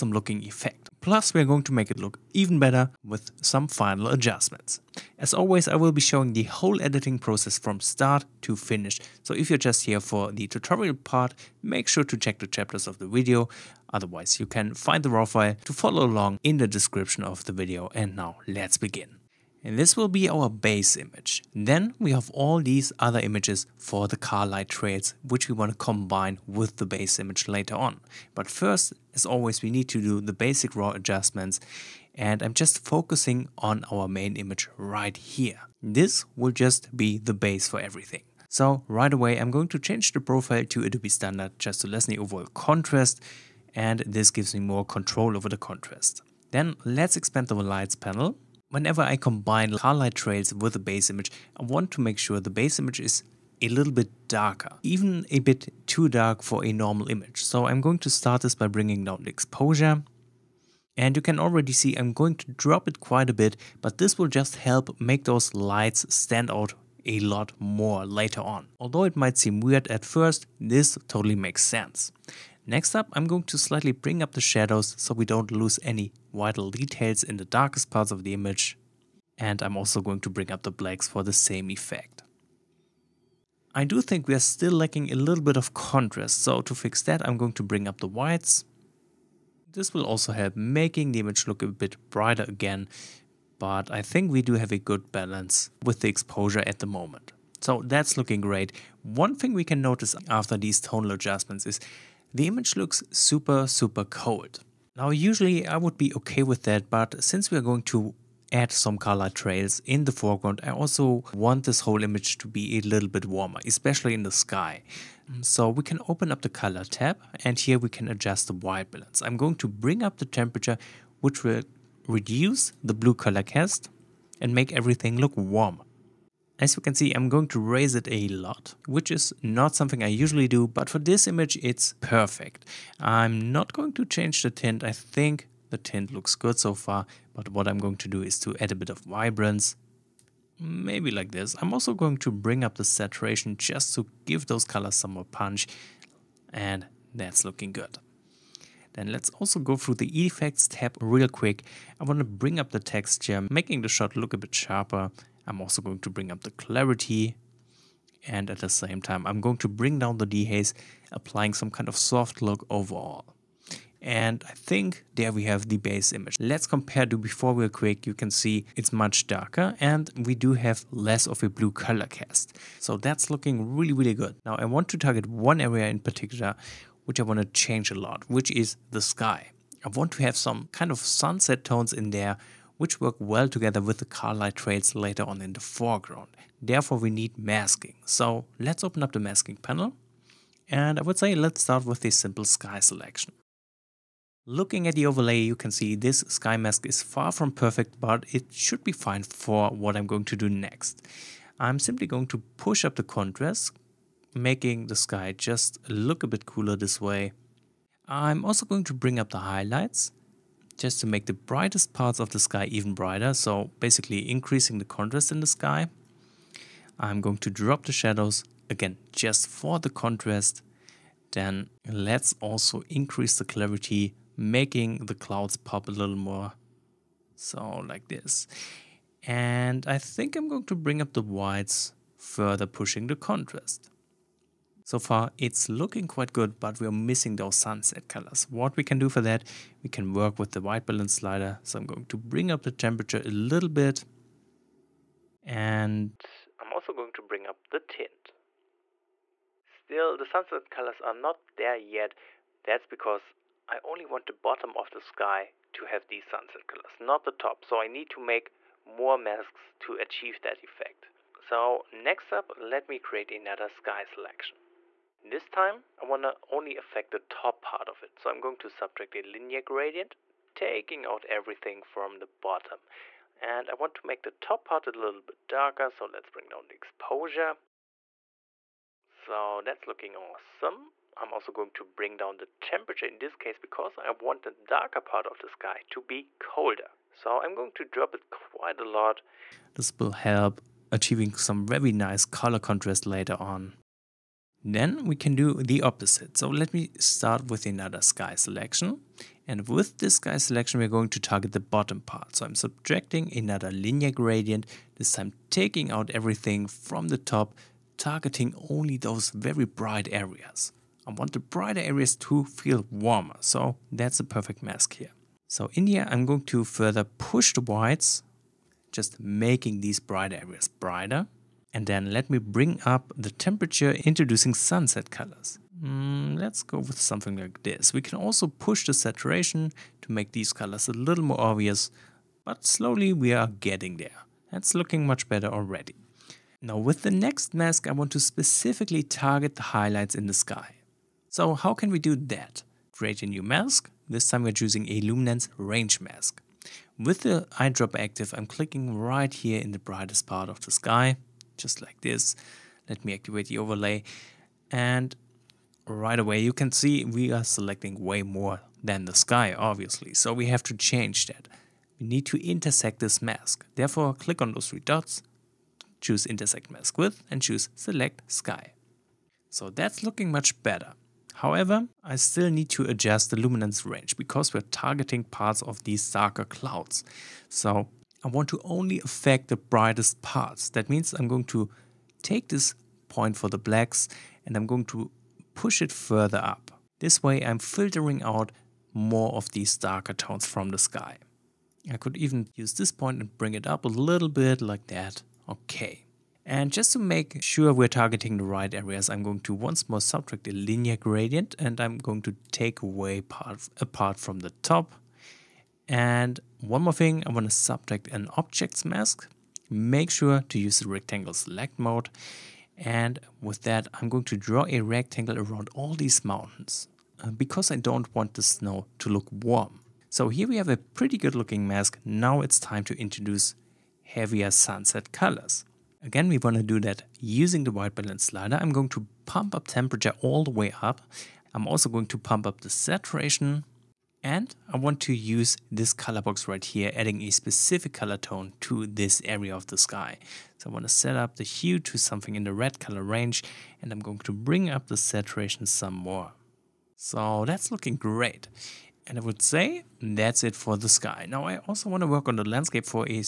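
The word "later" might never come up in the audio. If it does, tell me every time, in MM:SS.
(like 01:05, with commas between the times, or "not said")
00:27, 01:08, 03:04, 04:53.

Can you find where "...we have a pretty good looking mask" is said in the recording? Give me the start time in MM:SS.
07:00.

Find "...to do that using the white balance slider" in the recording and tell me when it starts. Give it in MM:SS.
07:06.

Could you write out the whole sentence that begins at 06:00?
So we have to change that.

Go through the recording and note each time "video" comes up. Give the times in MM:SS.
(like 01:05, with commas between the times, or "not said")
00:13, 00:17.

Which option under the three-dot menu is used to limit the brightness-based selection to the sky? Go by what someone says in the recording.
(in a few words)
intersect mask with.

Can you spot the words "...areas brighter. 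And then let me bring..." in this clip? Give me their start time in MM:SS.
05:20.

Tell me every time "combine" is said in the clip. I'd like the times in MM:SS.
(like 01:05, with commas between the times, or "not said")
00:25, 00:49.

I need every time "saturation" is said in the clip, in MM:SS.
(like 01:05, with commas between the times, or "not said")
02:22, 05:28, 07:12, 07:24.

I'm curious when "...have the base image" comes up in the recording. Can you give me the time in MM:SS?
02:45.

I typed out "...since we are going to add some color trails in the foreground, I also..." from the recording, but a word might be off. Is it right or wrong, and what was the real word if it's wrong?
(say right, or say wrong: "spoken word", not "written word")
right.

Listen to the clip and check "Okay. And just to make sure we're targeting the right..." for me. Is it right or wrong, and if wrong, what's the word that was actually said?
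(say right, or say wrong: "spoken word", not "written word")
right.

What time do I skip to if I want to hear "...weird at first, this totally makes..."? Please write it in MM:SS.
01:09.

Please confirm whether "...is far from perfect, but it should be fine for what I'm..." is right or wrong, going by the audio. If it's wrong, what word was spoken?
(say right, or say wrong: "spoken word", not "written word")
right.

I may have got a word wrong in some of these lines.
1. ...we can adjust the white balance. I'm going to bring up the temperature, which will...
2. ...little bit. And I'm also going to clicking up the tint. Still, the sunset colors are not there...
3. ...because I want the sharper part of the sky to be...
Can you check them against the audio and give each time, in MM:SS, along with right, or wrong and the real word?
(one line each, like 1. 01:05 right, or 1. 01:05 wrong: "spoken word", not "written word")
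1. 01:57 right
2. 04:03 wrong: "bring", not "clicking"
3. 04:43 wrong: "darker", not "sharper".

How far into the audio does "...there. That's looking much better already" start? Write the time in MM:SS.
05:33.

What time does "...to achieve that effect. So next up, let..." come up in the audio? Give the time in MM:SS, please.
04:19.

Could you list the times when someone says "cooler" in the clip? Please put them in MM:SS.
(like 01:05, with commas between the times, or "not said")
03:26.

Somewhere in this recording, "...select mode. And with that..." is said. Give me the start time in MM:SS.
06:51.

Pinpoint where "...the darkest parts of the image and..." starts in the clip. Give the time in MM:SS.
01:17.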